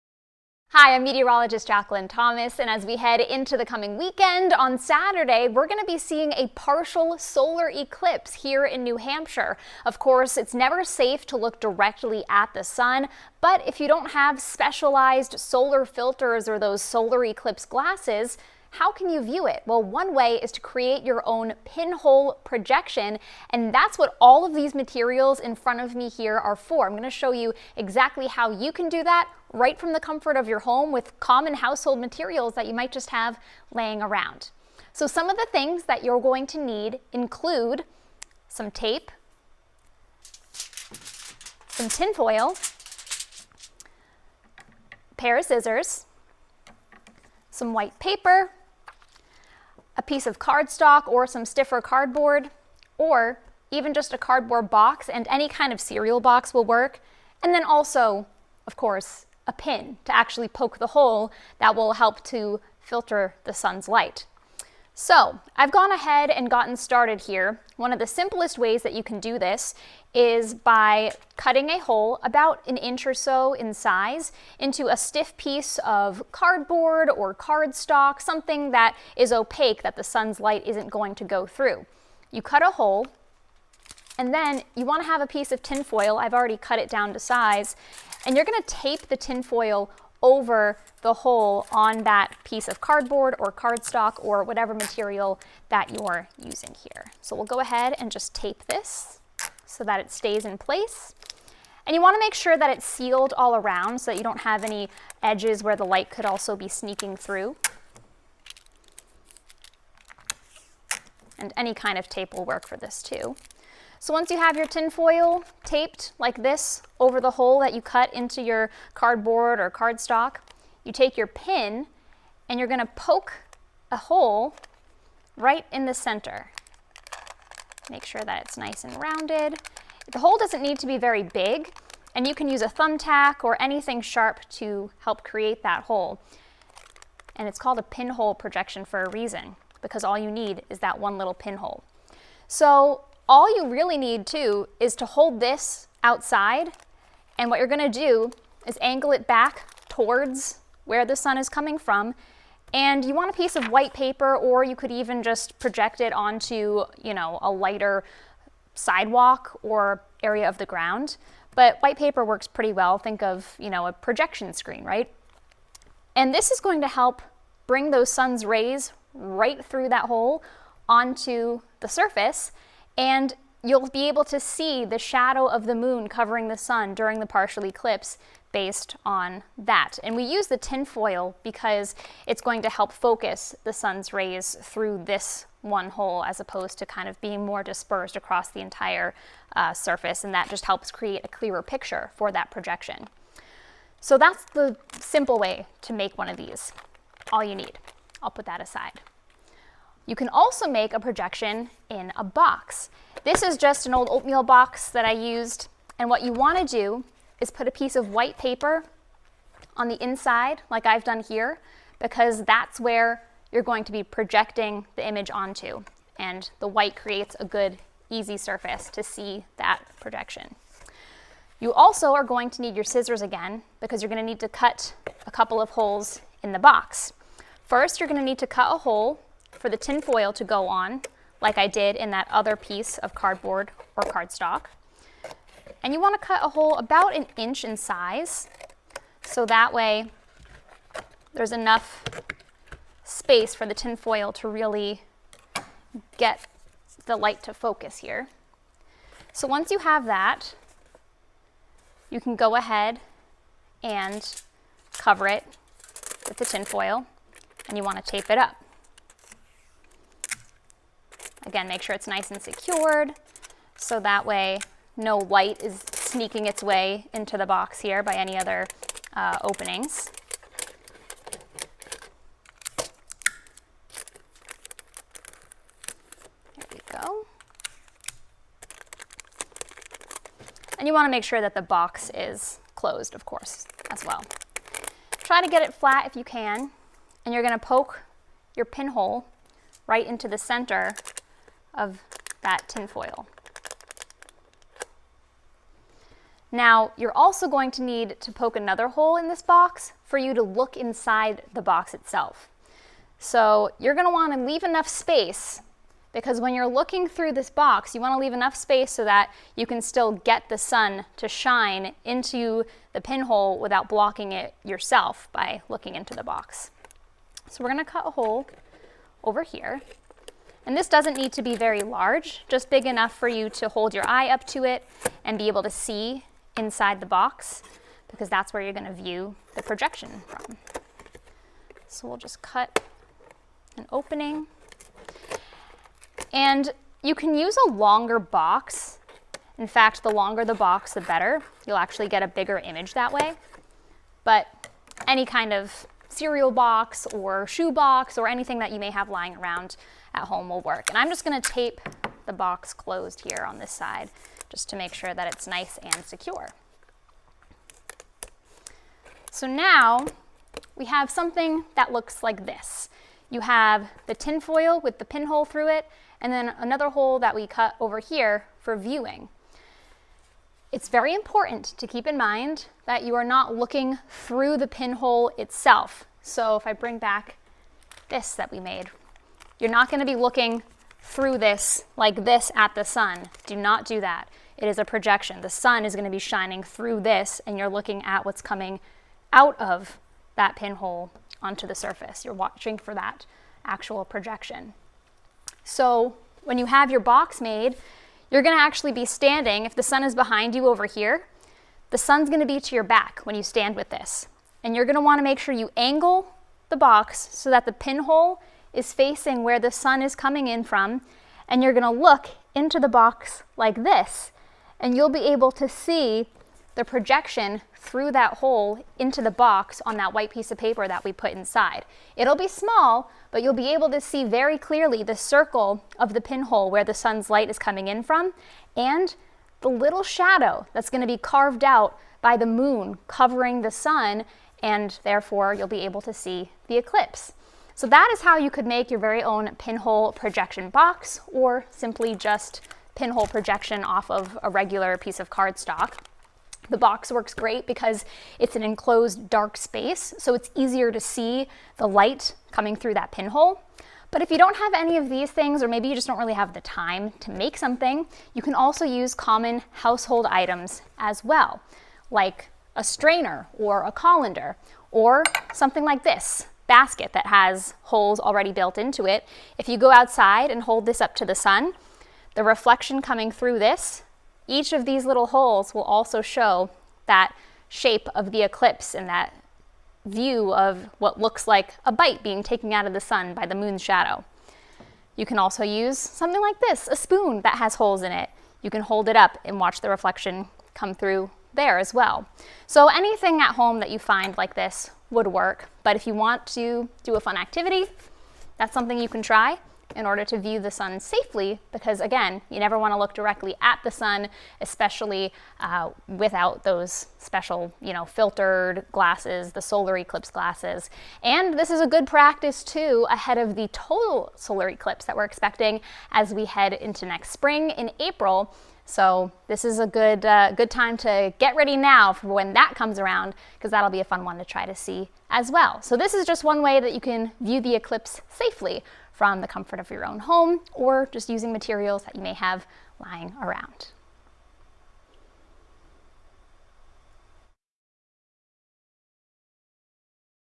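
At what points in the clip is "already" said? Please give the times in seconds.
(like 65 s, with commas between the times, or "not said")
86 s, 468 s.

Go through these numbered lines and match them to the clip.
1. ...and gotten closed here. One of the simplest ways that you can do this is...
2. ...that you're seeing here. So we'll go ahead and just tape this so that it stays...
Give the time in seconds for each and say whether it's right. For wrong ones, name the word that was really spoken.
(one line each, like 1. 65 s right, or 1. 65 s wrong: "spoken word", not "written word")
1. 66 s wrong: "started", not "closed"
2. 95 s wrong: "using", not "seeing".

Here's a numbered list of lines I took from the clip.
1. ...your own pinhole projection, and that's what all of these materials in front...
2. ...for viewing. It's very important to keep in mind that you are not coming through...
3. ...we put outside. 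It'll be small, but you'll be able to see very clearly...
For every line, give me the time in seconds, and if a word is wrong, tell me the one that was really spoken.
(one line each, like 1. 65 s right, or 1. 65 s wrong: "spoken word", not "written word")
1. 21 s right
2. 368 s wrong: "looking", not "coming"
3. 421 s wrong: "inside", not "outside".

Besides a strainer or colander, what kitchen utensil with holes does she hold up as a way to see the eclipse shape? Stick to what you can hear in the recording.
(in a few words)
a spoon.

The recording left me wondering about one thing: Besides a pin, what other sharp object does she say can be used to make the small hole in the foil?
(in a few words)
a thumbtack.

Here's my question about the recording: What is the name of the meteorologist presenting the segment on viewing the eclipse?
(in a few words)
Jacqueline Thomas.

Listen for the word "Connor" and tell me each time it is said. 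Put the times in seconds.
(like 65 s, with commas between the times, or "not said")
not said.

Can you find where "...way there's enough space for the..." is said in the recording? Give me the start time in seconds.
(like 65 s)
239 s.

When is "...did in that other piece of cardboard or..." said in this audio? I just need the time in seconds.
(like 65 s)
231 s.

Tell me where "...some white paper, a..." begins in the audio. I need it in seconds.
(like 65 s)
47 s.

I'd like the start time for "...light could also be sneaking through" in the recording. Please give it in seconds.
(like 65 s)
105 s.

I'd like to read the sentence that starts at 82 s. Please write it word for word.
You cut a hole and then you wanna have a piece of tin foil.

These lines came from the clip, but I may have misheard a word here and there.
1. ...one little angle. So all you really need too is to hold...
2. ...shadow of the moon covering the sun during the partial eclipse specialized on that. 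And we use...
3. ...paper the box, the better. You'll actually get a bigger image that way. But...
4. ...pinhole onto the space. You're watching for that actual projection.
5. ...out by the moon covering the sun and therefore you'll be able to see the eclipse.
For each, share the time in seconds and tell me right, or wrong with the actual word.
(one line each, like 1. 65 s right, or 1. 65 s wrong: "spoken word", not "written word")
1. 140 s wrong: "pinhole", not "angle"
2. 174 s wrong: "based", not "specialized"
3. 340 s wrong: "longer", not "paper"
4. 390 s wrong: "surface", not "space"
5. 431 s right.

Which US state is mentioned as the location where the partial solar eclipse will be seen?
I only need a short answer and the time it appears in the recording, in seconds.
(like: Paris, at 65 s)
New Hampshire, at 8 s.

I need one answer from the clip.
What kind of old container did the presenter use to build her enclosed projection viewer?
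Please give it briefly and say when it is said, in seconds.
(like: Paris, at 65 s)
oatmeal box, at 204 s.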